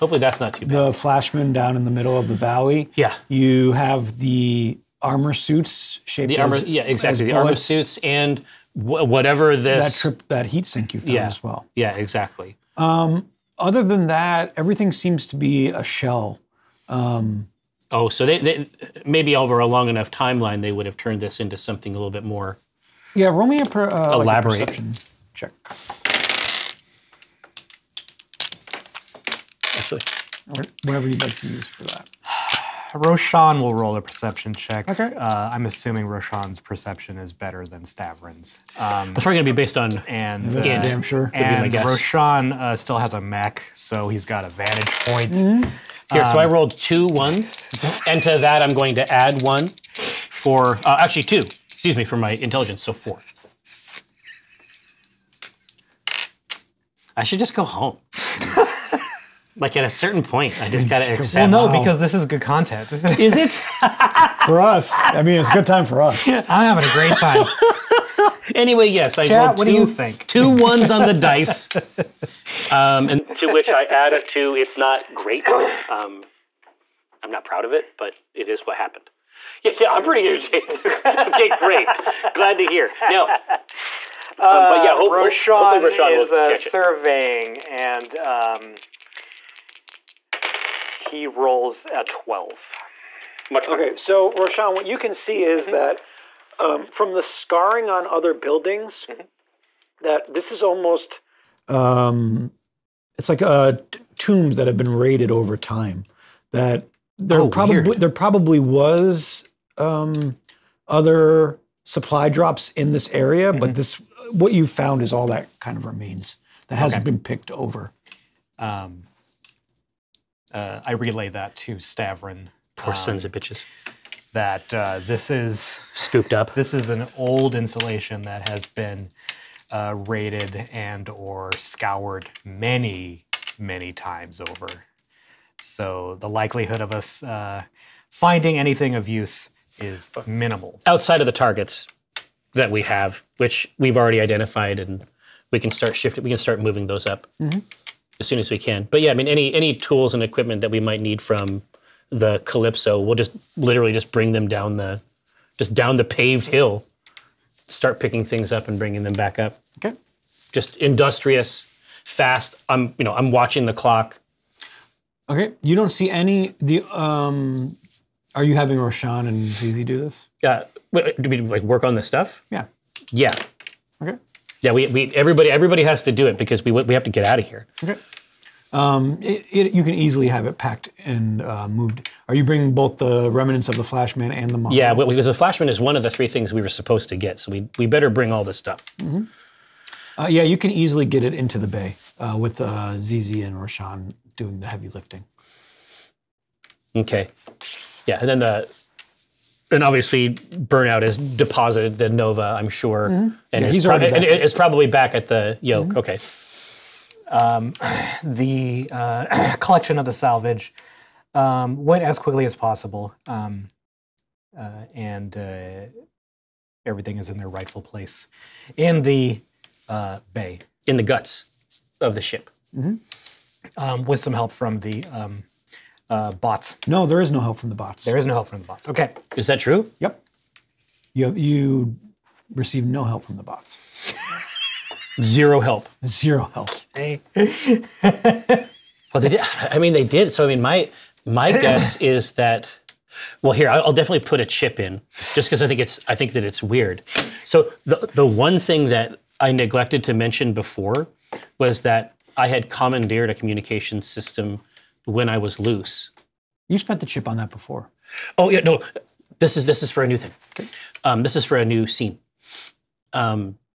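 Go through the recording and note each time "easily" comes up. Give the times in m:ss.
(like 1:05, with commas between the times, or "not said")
2:59, 3:10.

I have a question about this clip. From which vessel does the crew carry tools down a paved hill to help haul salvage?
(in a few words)
the Calypso.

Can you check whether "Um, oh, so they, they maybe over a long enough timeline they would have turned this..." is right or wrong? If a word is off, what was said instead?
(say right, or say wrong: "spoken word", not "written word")
right.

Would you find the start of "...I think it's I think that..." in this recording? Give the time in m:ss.
4:05.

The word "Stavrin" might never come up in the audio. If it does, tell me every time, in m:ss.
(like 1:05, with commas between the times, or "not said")
0:37, 2:01.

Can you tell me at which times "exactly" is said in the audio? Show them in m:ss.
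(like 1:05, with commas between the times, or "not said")
0:06, 0:11.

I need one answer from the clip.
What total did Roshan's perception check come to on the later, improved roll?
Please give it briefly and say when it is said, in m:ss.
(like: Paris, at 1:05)
12, at 1:32.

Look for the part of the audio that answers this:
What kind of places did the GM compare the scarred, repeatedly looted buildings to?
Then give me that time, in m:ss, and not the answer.
1:44.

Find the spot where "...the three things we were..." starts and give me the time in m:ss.
3:06.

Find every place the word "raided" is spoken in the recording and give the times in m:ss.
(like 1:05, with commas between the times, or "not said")
1:44, 2:10.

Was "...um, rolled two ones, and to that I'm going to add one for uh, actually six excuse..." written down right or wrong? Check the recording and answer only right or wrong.
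wrong.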